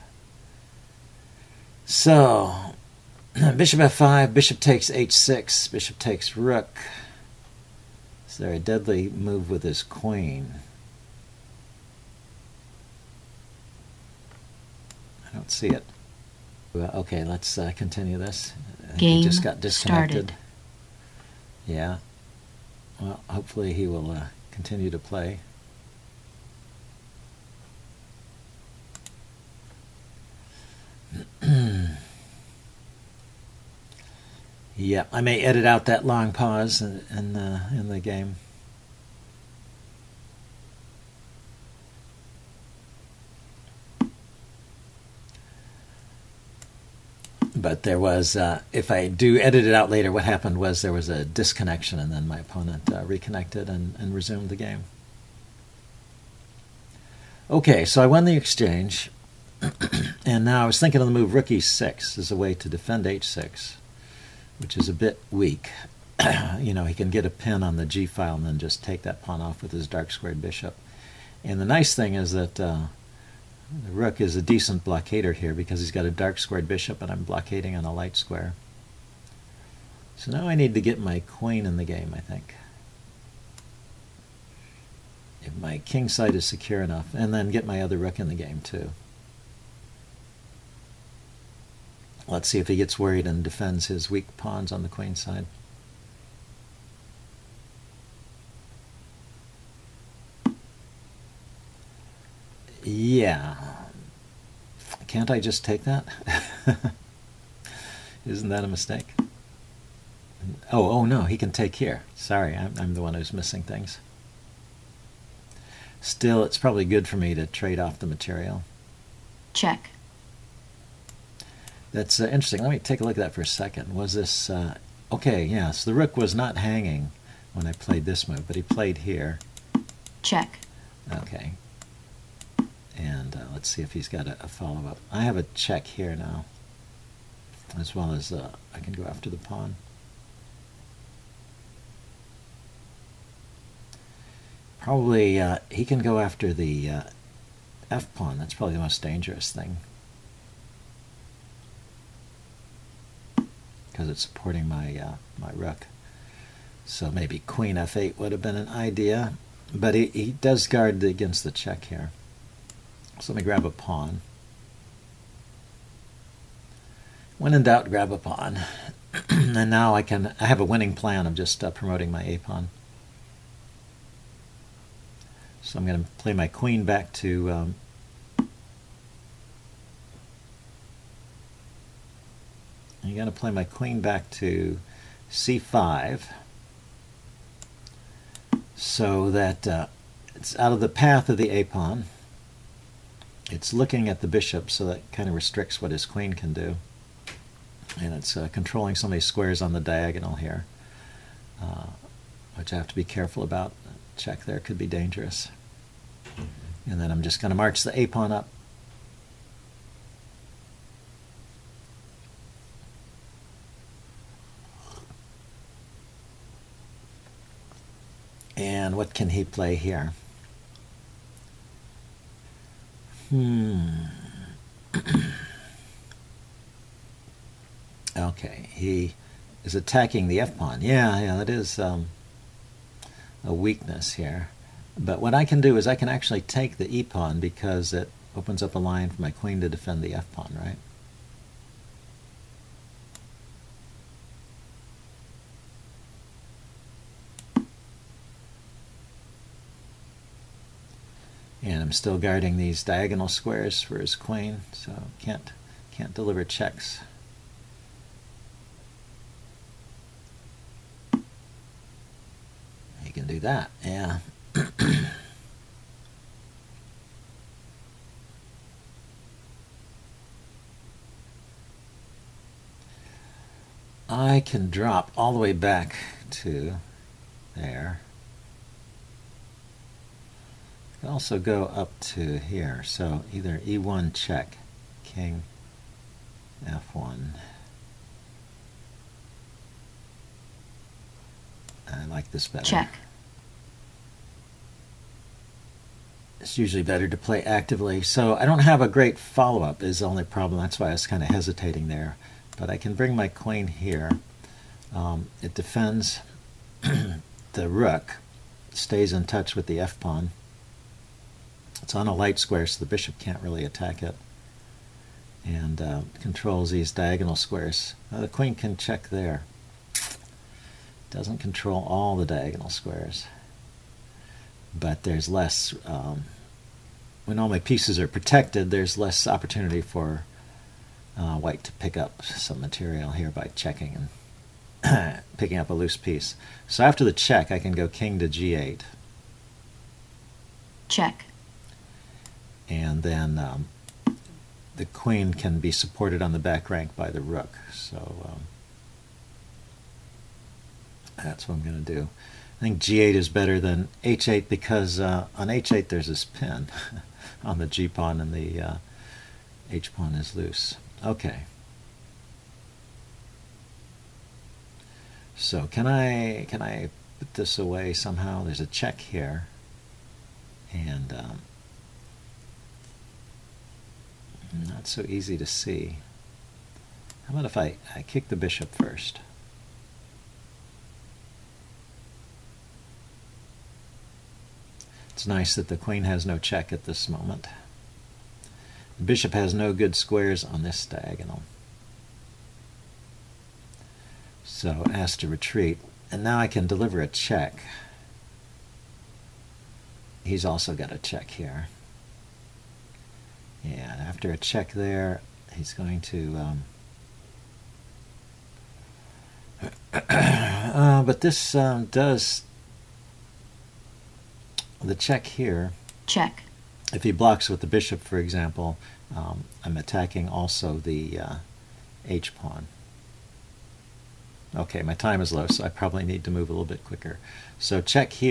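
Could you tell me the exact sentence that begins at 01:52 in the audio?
Sorry, I'm, I'm the one who's missing things.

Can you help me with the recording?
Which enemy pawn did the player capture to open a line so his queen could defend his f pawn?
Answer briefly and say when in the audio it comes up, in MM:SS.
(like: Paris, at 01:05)
The e pawn, at 03:56.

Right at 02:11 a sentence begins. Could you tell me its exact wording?
Okay, and uh, let's see if he's got a, a follow up.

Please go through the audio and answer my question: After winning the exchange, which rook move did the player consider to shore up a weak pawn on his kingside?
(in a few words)
Rook e6.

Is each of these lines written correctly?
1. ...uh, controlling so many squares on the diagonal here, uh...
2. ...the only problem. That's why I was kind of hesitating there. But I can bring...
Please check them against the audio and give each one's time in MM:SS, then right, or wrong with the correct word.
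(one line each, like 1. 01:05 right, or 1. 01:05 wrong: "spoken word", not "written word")
1. 03:18 right
2. 04:59 right.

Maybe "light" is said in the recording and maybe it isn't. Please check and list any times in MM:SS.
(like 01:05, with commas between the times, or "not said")
01:17, 05:12.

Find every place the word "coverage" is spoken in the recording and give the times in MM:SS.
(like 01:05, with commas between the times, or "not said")
not said.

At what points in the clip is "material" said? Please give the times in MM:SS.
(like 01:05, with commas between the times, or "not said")
01:58, 05:32.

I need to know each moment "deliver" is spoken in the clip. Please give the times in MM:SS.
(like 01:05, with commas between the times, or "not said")
04:16, 06:36.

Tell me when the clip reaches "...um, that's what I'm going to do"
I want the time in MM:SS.
05:48.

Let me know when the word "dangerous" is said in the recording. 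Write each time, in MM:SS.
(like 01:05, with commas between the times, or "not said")
02:29, 03:24.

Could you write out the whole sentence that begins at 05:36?
So after the check, I can go king to g8.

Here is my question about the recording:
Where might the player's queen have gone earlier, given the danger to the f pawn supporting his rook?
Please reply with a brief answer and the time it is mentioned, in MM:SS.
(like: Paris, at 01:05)
f8, at 02:37.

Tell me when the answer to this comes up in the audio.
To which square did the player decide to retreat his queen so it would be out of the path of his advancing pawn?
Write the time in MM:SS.
03:05.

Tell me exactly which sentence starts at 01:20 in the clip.
So now I need to get my queen in the game, I think.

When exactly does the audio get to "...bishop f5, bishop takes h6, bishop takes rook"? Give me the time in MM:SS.
00:03.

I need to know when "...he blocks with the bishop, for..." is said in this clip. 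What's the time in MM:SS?
06:57.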